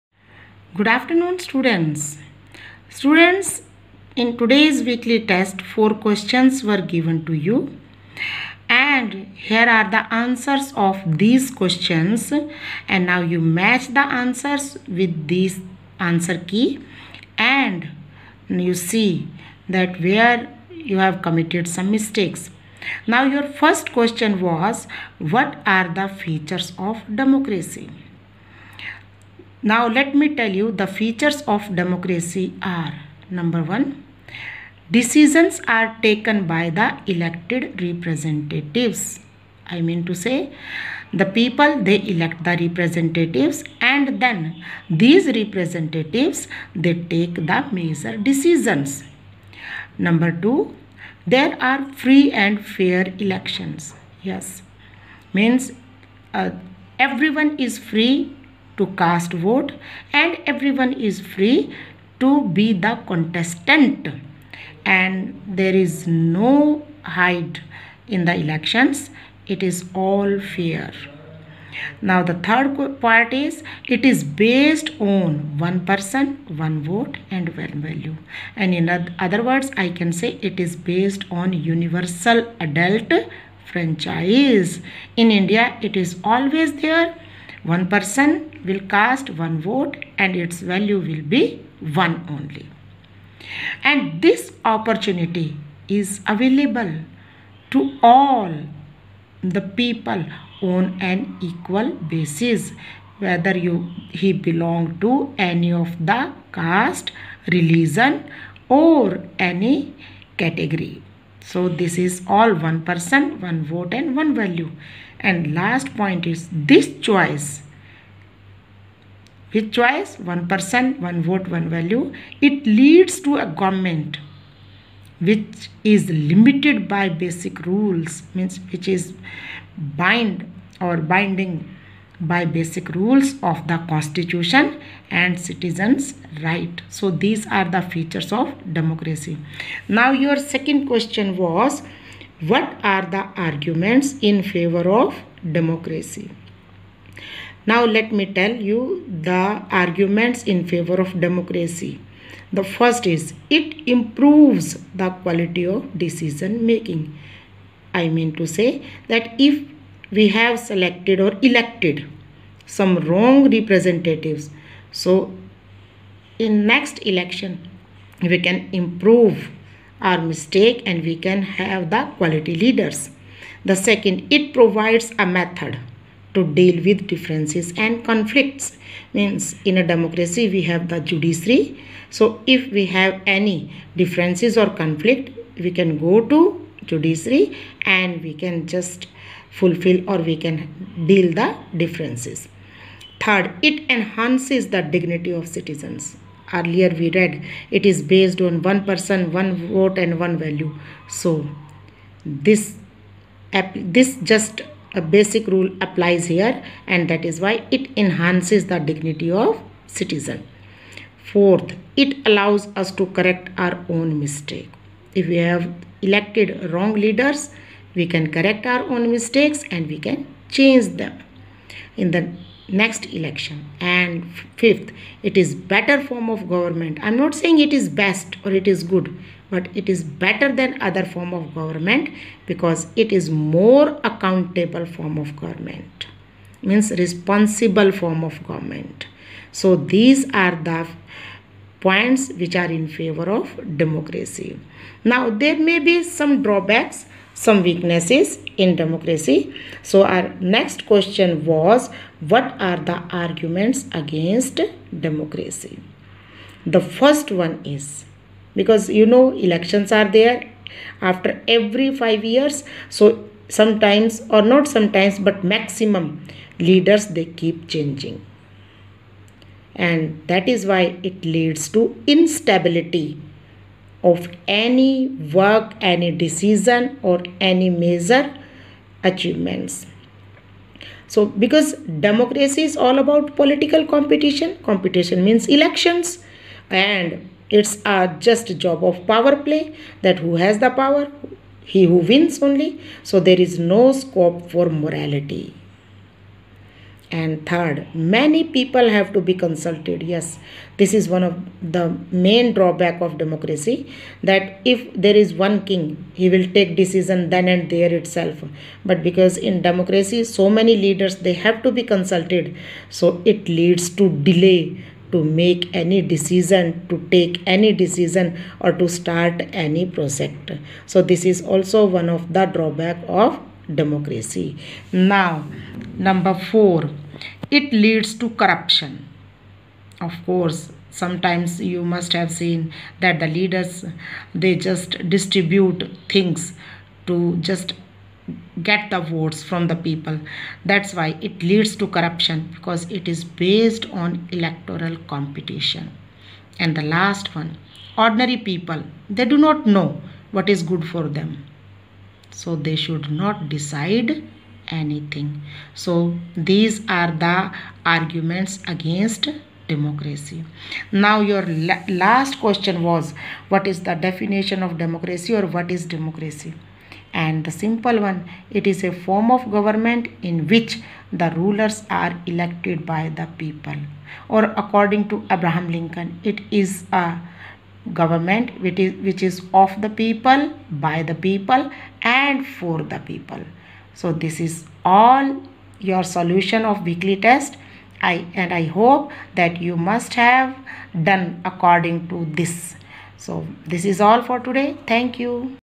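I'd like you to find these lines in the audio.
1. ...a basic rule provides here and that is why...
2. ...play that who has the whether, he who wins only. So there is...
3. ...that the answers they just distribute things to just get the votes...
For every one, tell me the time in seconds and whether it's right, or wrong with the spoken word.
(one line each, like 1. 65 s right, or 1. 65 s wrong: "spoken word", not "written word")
1. 204 s wrong: "applies", not "provides"
2. 289 s wrong: "power", not "whether"
3. 333 s wrong: "leaders", not "answers".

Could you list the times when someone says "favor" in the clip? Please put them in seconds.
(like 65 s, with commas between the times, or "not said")
144 s, 150 s, 242 s.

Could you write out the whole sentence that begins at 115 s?
And last point is this choice.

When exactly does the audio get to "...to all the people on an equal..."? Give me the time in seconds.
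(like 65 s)
97 s.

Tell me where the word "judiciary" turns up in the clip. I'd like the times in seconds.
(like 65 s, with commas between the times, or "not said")
181 s, 186 s.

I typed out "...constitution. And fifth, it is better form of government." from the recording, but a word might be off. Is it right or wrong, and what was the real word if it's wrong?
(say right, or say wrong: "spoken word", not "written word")
wrong: "election", not "constitution".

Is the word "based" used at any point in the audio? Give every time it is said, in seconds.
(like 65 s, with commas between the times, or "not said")
74 s, 80 s, 198 s, 343 s.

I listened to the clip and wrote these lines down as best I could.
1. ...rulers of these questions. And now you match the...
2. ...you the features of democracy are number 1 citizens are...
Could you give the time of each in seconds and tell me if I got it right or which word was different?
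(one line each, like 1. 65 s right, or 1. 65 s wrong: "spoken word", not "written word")
1. 10 s wrong: "answers", not "rulers"
2. 30 s wrong: "decisions", not "citizens".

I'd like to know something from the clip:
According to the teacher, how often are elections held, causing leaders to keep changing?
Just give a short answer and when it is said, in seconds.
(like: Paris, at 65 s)
every 5 years, at 261 s.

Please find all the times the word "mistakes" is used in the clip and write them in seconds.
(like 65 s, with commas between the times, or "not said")
21 s, 170 s, 214 s, 219 s.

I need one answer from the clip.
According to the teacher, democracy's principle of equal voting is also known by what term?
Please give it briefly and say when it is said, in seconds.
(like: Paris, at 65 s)
universal adult franchise, at 81 s.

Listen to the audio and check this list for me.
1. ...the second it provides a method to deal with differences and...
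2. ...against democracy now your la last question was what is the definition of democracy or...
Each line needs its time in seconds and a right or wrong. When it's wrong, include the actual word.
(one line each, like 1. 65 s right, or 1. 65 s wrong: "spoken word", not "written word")
1. 173 s right
2. 358 s right.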